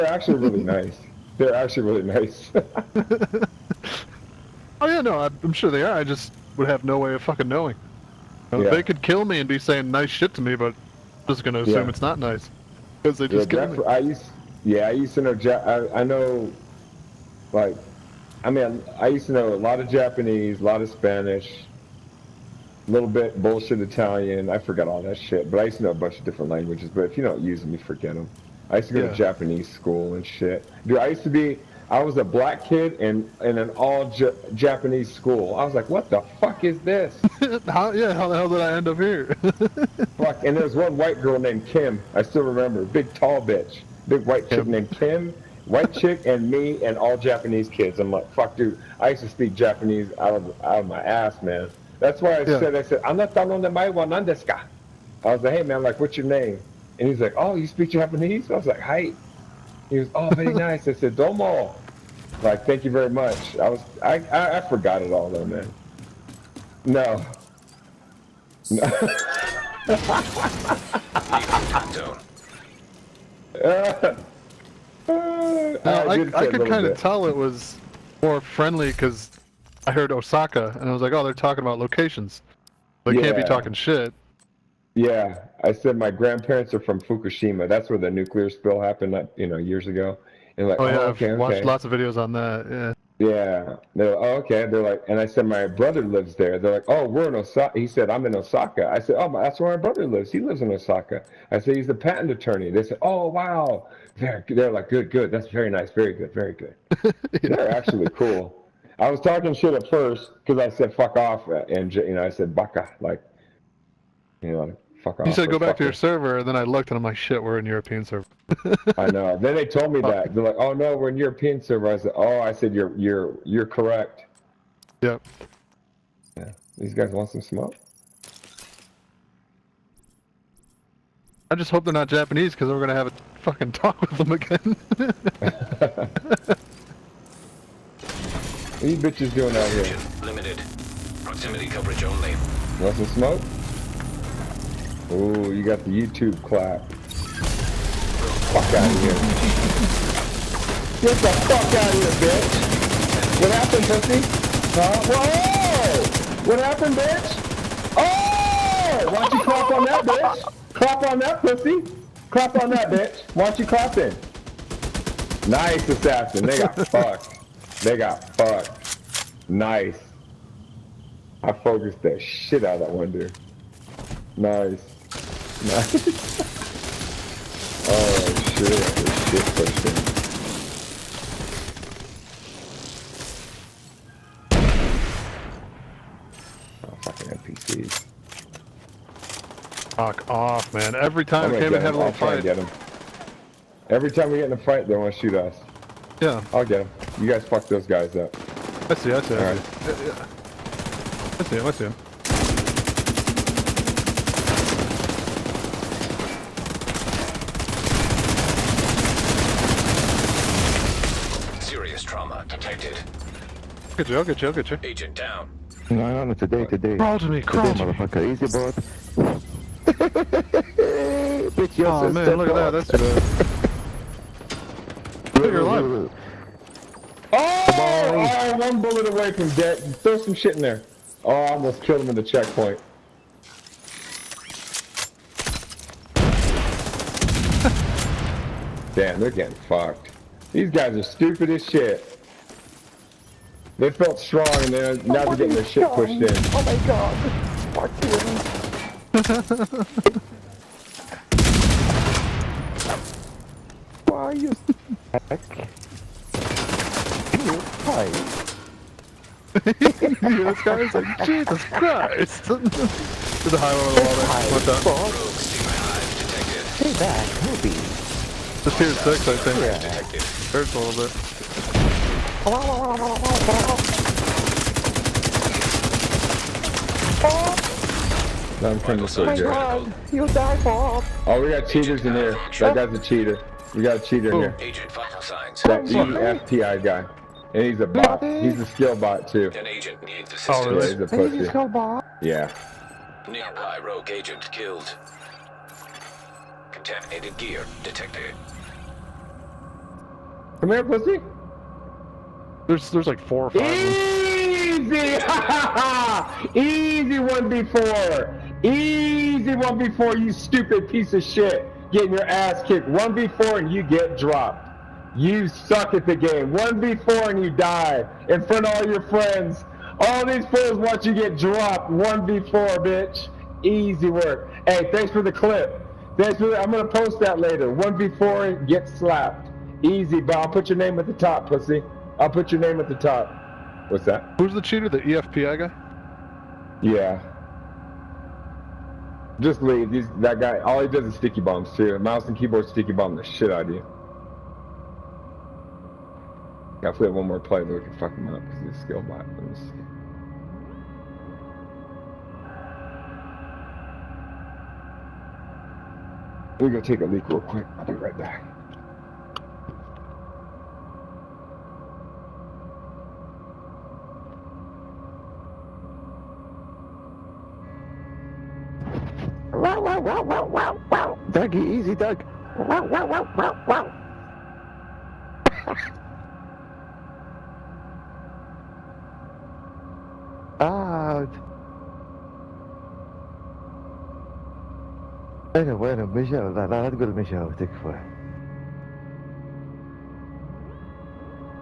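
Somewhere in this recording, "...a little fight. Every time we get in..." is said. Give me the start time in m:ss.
3:11.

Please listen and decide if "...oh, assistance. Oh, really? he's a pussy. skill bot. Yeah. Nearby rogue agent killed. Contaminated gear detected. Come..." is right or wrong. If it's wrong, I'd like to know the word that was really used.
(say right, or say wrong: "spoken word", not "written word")
right.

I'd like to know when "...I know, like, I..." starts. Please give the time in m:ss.
0:15.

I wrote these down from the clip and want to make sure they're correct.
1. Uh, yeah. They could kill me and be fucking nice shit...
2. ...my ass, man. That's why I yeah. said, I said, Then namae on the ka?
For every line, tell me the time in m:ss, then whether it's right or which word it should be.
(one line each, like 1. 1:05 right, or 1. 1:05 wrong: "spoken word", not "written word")
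1. 0:08 wrong: "saying", not "fucking"
2. 0:50 wrong: "Anatano", not "Then".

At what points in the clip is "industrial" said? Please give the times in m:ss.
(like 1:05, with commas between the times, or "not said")
not said.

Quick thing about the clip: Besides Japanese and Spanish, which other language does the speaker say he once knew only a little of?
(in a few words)
Italian.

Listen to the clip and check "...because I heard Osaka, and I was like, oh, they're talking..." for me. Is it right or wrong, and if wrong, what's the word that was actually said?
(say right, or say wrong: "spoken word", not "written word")
right.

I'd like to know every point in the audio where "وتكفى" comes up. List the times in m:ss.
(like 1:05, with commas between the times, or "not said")
6:27.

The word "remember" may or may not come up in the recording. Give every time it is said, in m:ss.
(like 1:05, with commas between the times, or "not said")
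0:42.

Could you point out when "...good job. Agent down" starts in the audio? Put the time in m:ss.
3:34.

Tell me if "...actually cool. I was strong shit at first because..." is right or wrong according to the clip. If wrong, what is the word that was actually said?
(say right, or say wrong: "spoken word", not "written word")
wrong: "talking", not "strong".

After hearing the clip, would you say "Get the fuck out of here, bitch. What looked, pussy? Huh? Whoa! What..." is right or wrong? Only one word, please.
wrong.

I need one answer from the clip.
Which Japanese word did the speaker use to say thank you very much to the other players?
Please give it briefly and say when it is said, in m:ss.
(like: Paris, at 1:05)
domo, at 1:01.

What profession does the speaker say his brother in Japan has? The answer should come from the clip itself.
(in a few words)
patent attorney.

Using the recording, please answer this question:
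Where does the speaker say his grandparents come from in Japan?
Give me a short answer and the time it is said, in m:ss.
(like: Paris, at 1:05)
Fukushima, at 1:26.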